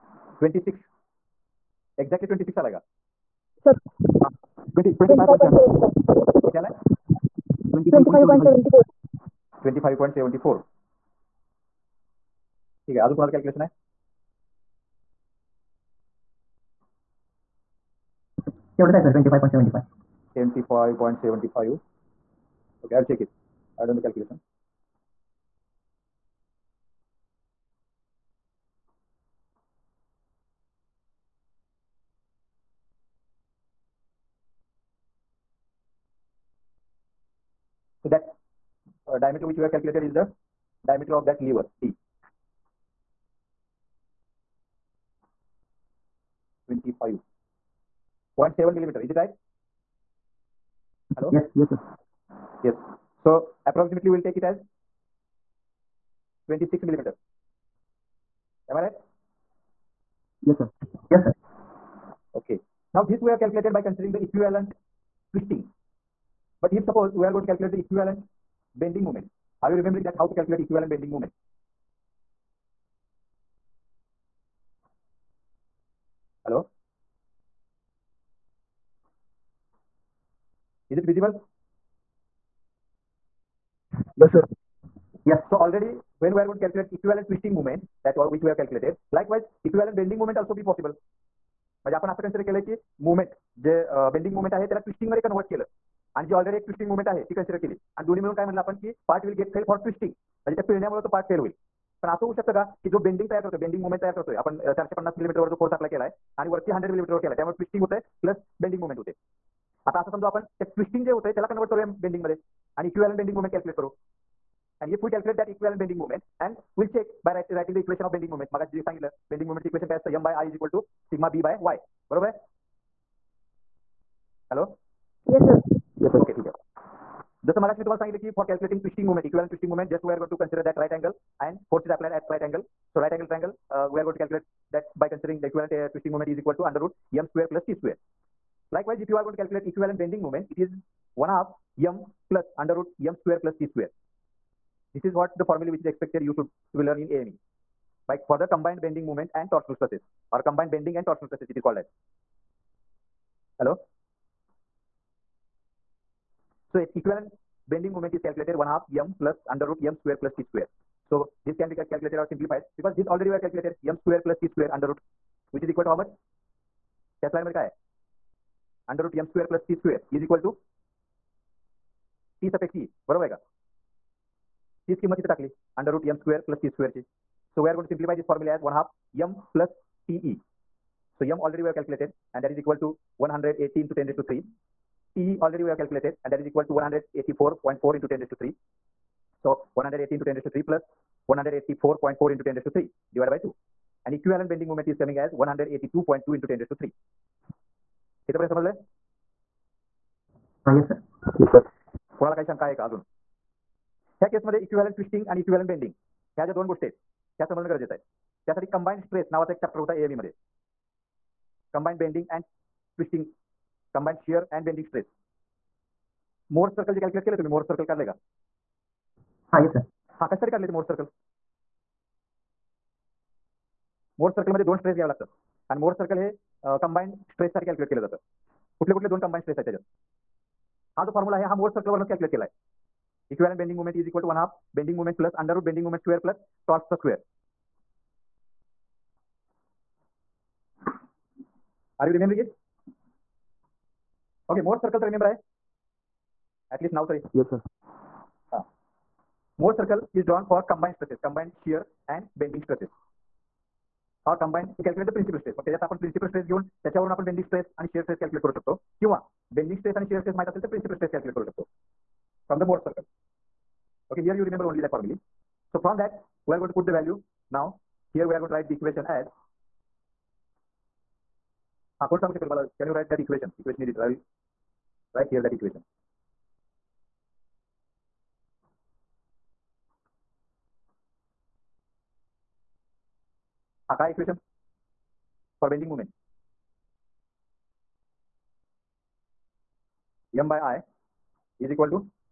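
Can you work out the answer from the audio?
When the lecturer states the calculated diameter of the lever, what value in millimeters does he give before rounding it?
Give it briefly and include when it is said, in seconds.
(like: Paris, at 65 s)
25.7, at 46 s.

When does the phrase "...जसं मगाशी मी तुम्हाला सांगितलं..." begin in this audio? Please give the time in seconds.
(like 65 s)
127 s.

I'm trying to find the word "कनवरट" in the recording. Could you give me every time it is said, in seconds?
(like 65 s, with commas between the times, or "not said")
95 s, 111 s.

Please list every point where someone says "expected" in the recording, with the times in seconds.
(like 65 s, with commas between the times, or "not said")
145 s.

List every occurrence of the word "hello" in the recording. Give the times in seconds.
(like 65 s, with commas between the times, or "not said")
51 s, 153 s.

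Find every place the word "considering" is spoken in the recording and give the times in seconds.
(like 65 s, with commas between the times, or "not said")
63 s.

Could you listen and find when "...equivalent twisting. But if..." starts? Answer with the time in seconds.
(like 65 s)
64 s.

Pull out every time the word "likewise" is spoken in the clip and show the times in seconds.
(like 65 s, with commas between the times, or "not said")
89 s, 138 s.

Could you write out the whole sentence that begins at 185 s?
TE already we have calculated and that is equal to 184.4 into 10 raised to 3.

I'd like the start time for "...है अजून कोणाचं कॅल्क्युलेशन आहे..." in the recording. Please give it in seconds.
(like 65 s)
12 s.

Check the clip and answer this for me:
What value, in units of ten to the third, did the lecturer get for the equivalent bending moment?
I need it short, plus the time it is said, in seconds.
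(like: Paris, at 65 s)
182.2, at 195 s.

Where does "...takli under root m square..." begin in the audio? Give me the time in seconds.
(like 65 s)
175 s.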